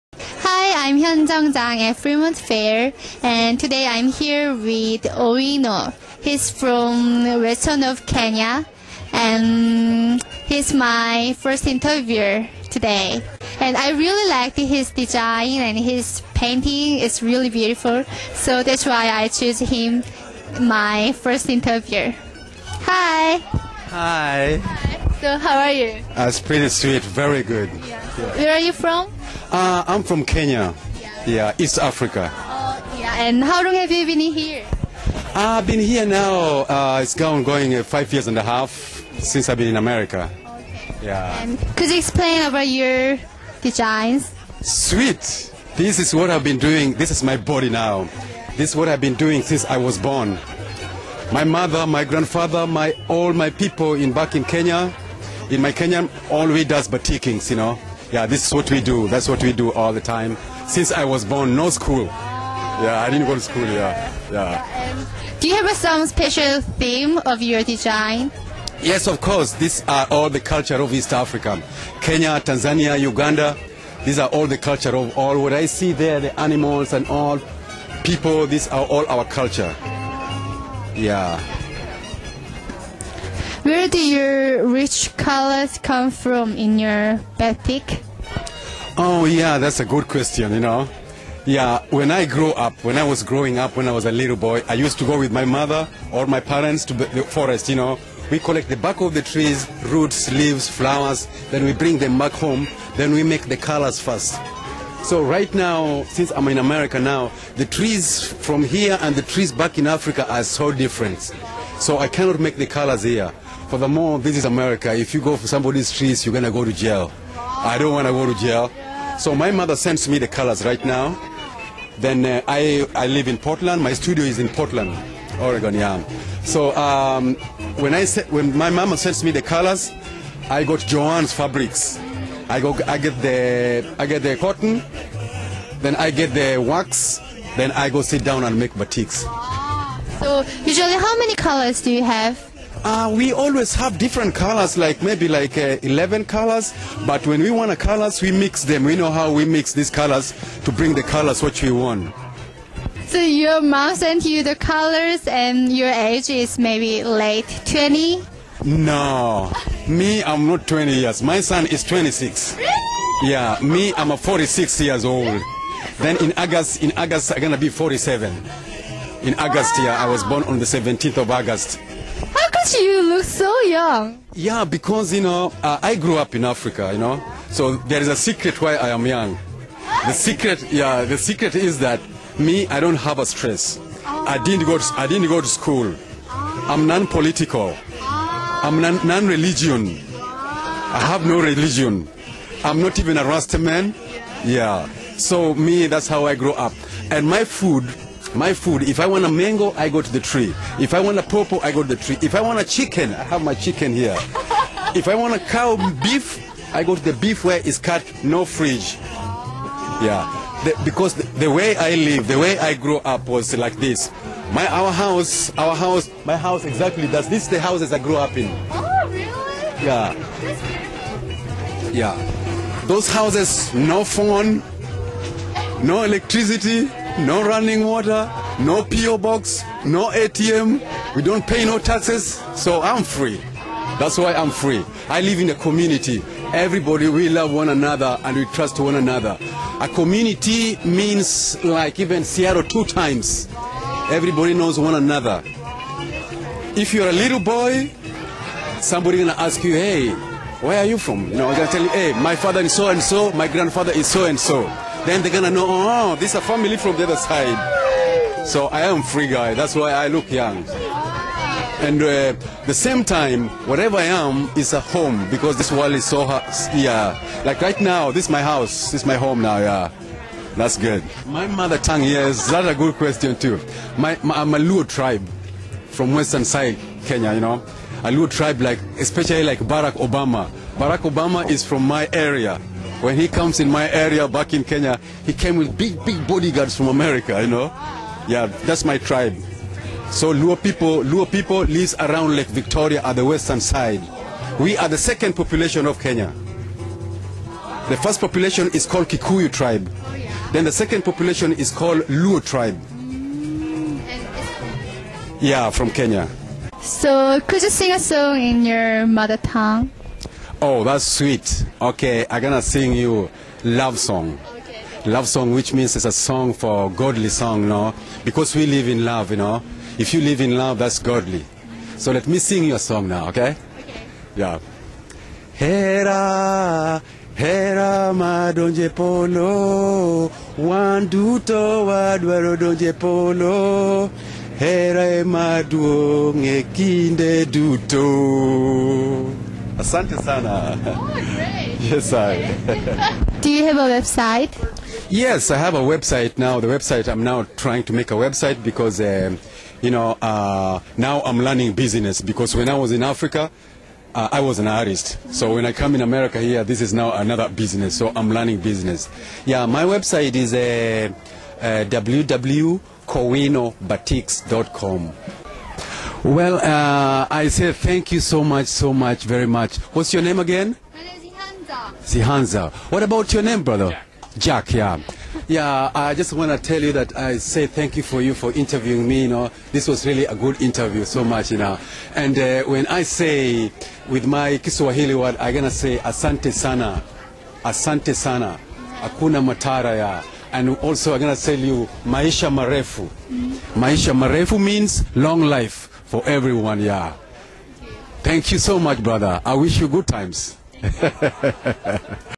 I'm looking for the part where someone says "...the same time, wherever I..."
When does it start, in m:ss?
4:22.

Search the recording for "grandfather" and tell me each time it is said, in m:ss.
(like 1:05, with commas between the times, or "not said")
0:52, 4:13.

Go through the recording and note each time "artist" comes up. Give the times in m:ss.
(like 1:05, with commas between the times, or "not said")
5:54.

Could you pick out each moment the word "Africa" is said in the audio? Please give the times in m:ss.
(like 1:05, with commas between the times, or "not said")
0:31, 1:11, 1:49, 2:56, 5:53.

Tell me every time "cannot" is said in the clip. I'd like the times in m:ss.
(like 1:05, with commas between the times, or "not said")
1:52.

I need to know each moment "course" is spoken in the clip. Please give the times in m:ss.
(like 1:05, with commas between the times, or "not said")
1:09.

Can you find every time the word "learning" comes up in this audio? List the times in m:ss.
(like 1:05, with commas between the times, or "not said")
5:51, 5:58.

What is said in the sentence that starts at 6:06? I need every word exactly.
Well, uh, I say thank you so much, so much, very much.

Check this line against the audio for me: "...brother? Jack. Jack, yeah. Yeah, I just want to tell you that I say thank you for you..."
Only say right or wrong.
right.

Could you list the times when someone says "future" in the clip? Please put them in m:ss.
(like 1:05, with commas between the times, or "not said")
not said.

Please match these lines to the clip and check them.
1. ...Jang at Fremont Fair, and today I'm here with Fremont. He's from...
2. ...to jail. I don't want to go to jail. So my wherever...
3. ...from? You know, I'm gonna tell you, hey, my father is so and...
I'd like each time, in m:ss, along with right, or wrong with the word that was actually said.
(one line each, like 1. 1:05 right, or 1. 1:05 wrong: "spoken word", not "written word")
1. 0:01 wrong: "Owino", not "Fremont"
2. 1:56 wrong: "mother", not "wherever"
3. 4:10 right.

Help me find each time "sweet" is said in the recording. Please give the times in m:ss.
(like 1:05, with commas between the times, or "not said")
0:26, 0:44, 5:11.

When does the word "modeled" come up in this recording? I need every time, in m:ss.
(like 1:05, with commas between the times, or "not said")
not said.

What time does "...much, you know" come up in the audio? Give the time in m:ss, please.
6:21.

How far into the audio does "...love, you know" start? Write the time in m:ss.
5:19.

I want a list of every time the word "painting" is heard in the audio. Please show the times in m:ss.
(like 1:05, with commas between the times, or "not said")
0:16.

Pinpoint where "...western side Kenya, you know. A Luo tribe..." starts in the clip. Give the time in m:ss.
4:36.